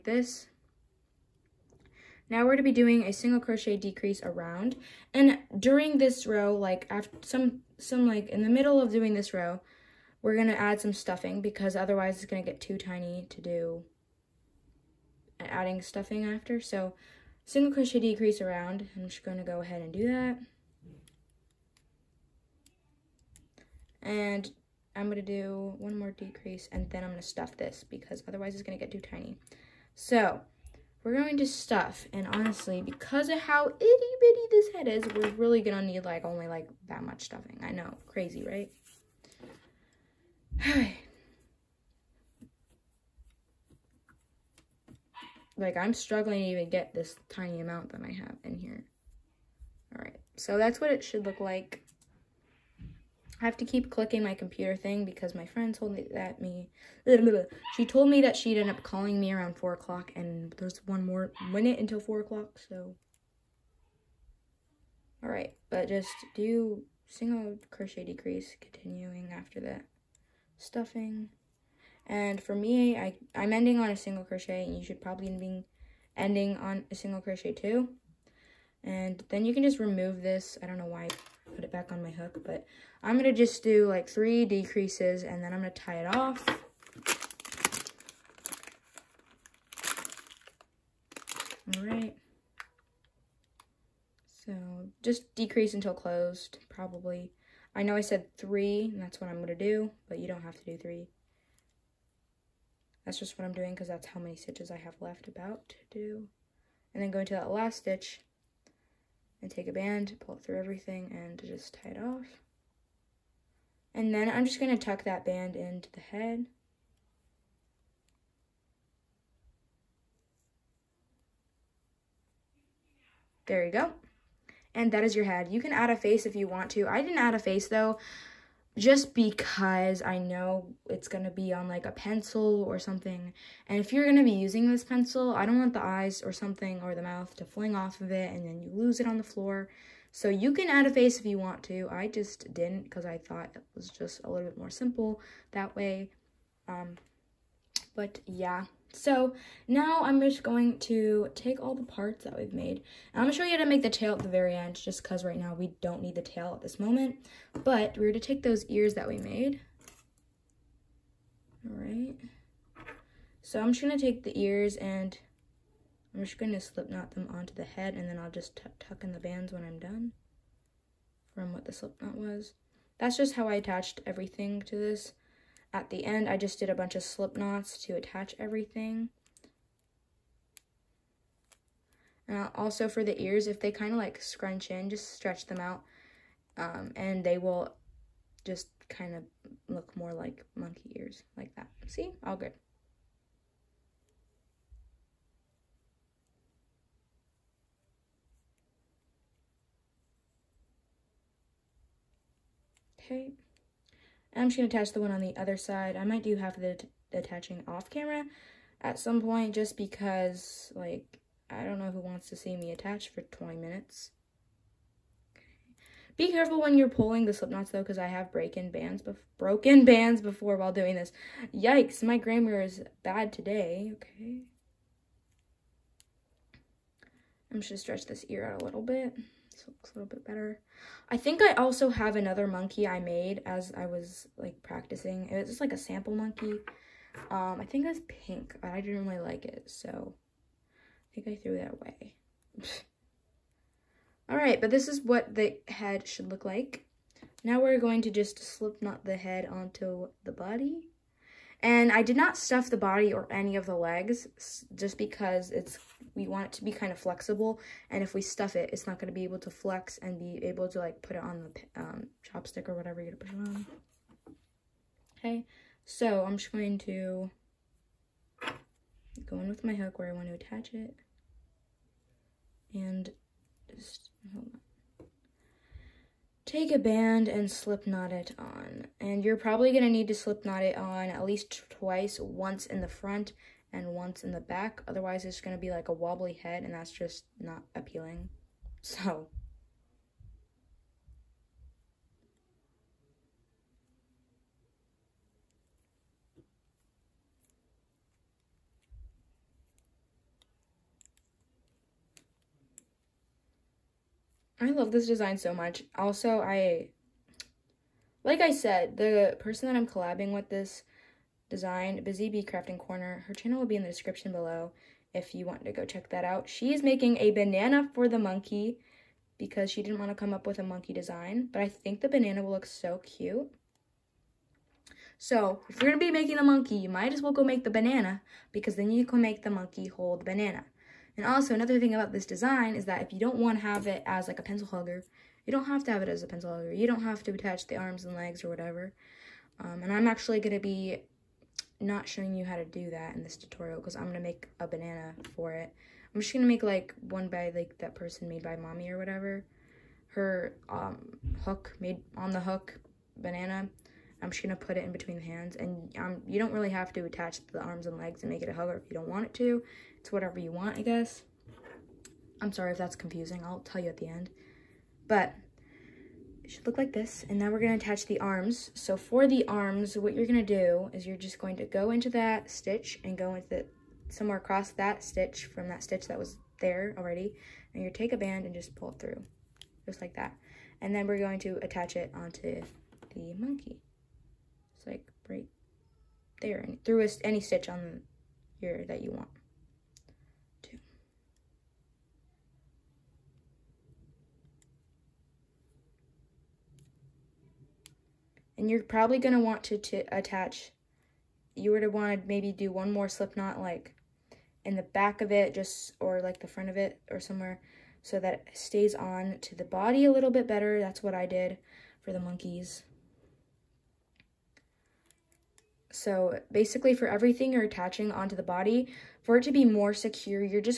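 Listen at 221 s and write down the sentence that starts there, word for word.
Yikes, my grammar is bad today.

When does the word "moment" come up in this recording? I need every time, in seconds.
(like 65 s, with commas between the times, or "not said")
156 s.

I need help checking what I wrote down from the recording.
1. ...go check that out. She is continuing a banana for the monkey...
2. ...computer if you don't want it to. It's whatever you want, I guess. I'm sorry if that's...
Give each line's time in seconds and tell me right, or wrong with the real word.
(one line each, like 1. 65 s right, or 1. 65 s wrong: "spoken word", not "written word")
1. 315 s wrong: "making", not "continuing"
2. 358 s wrong: "hugger", not "computer".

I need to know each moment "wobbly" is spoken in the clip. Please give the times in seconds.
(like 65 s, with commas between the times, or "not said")
285 s.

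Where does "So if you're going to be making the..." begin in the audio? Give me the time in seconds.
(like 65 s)
325 s.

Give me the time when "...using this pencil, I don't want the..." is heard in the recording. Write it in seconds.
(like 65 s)
134 s.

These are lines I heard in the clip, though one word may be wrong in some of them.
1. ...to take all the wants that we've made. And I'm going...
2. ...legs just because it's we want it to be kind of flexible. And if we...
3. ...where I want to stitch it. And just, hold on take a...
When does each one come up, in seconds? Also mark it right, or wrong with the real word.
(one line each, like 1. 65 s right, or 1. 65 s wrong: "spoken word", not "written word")
1. 150 s wrong: "parts", not "wants"
2. 253 s right
3. 269 s wrong: "attach", not "stitch".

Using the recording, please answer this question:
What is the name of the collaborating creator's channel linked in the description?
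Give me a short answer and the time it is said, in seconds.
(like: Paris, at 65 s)
Busy Bee Crafting Corner, at 312 s.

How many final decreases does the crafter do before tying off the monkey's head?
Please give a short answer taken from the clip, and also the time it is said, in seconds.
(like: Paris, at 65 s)
3, at 84 s.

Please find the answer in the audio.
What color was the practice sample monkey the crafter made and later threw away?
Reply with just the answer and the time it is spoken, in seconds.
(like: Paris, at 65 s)
Pink, at 238 s.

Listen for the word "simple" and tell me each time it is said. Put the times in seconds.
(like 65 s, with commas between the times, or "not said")
144 s.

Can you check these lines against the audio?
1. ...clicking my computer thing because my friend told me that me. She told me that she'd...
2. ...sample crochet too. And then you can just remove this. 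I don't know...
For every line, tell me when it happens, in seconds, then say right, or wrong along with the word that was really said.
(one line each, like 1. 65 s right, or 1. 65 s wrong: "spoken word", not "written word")
1. 53 s right
2. 76 s wrong: "single", not "sample".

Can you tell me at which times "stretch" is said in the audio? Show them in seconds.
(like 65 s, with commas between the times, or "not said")
185 s, 227 s.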